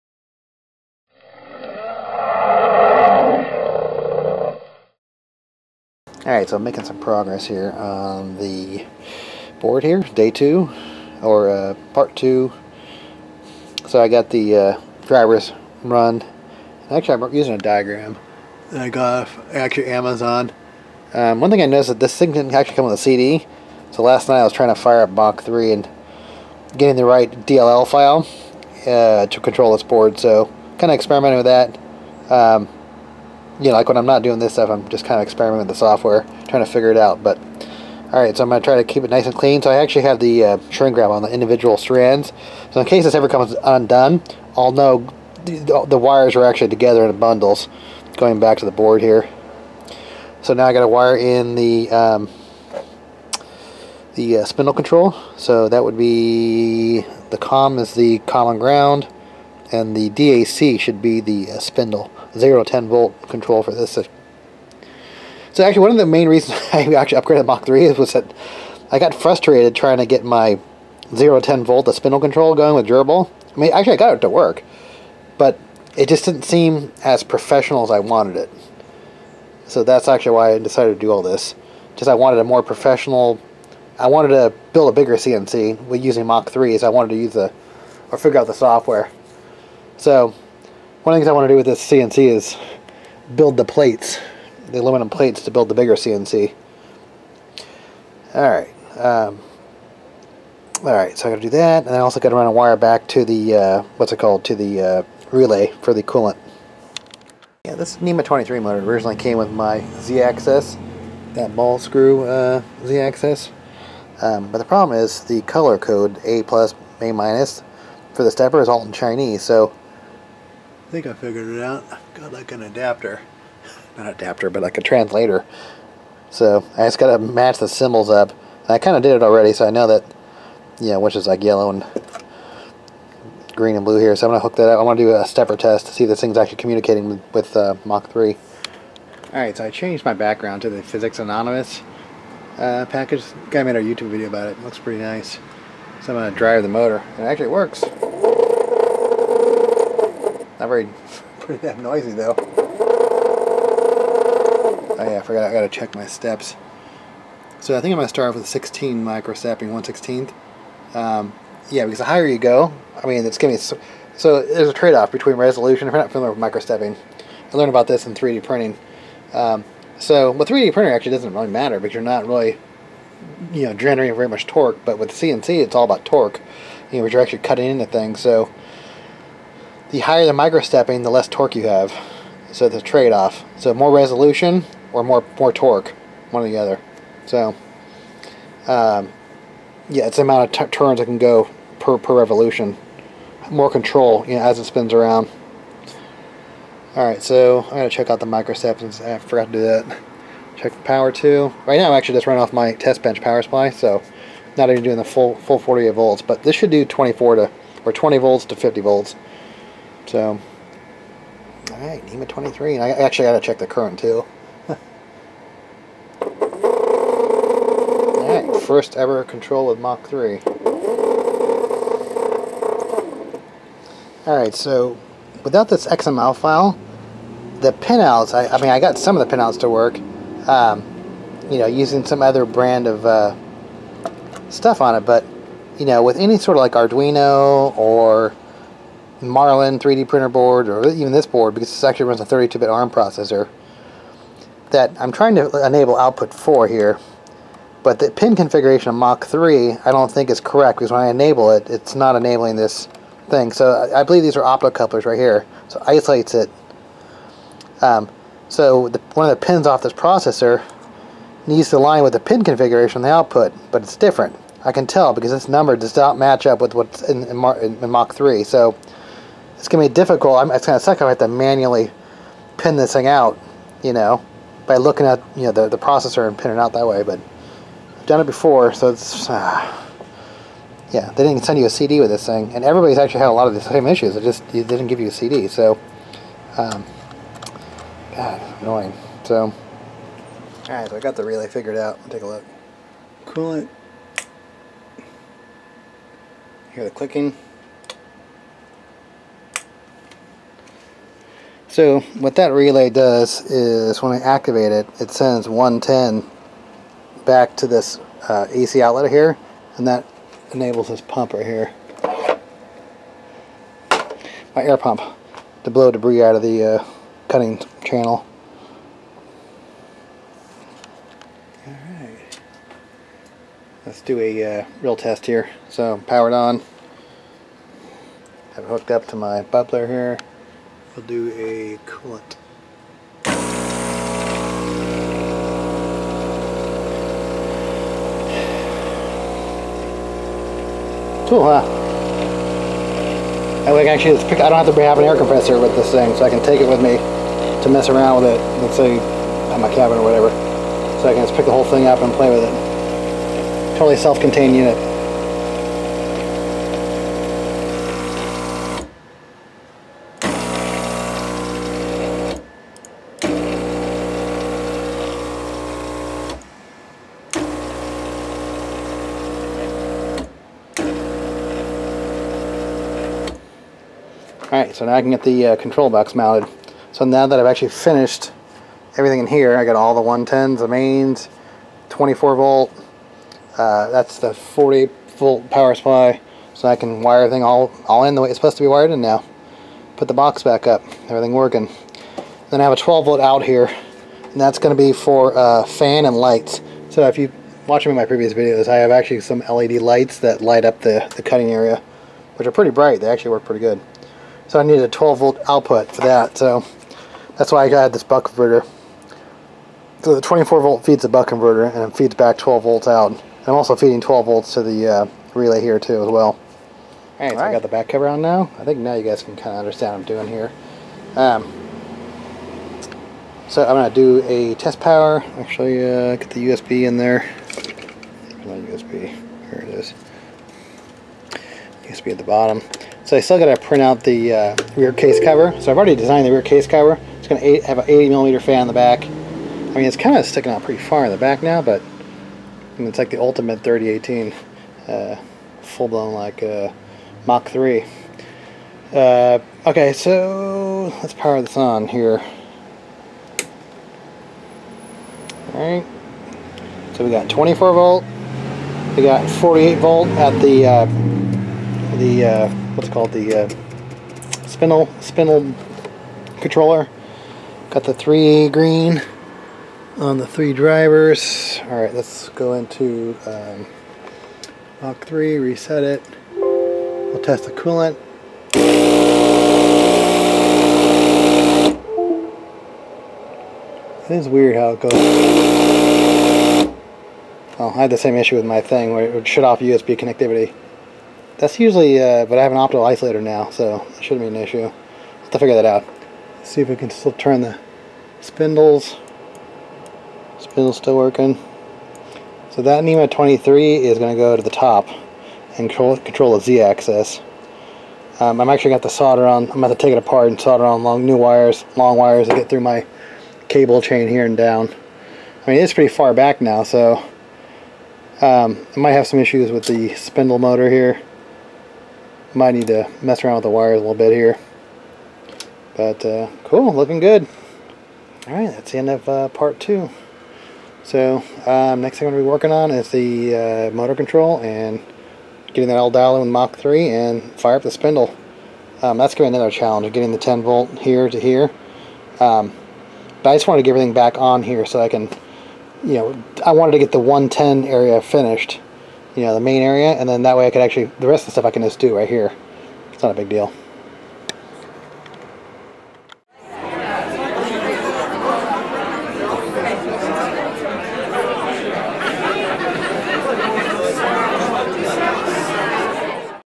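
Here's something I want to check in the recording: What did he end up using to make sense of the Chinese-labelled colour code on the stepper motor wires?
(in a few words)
translator.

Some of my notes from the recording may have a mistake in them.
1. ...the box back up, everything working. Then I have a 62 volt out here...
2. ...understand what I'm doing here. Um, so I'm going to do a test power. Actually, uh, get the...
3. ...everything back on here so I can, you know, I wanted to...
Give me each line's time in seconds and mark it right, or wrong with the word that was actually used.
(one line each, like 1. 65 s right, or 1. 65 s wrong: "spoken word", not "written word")
1. 390 s wrong: "12", not "62"
2. 419 s right
3. 543 s right.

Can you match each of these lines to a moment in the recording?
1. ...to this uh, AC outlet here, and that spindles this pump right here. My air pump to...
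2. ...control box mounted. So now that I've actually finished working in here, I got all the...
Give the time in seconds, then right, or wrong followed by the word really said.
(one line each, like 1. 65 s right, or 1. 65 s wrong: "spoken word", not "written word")
1. 307 s wrong: "enables", not "spindles"
2. 375 s wrong: "everything", not "working".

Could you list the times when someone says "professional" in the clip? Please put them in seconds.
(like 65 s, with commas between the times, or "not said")
77 s, 82 s.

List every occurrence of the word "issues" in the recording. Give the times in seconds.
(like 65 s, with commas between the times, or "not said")
283 s, 488 s, 494 s, 519 s.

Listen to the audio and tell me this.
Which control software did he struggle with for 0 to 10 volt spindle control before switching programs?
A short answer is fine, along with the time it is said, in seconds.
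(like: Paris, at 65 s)
GRBL, at 72 s.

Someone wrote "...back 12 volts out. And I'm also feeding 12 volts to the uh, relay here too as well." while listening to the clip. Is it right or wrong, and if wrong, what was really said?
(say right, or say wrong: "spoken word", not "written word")
right.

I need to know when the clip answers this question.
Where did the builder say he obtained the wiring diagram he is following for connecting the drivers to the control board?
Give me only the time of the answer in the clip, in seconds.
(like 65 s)
19 s.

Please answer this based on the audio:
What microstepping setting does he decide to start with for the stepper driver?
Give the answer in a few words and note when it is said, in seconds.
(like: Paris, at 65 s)
1/16, at 159 s.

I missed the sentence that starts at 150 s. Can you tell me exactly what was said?
Not very, pretty damn noisy though.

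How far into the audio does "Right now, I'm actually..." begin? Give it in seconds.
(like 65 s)
201 s.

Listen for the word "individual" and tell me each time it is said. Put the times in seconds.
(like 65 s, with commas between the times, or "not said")
41 s.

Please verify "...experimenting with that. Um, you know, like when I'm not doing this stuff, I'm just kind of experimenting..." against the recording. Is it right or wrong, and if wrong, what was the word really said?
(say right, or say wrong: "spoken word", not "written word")
right.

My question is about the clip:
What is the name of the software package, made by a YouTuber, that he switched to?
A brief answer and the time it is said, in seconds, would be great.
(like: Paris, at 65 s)
Physics Anonymous, at 140 s.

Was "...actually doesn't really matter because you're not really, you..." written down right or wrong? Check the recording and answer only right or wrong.
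right.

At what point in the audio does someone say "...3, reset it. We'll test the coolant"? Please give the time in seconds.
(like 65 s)
475 s.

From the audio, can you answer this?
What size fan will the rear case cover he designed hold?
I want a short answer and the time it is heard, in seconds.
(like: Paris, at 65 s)
80 millimeter, at 437 s.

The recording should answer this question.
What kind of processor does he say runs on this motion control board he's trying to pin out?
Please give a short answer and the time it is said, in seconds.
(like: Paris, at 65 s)
32-bit ARM, at 242 s.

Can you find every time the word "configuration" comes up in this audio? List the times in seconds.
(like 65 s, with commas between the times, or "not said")
248 s, 262 s.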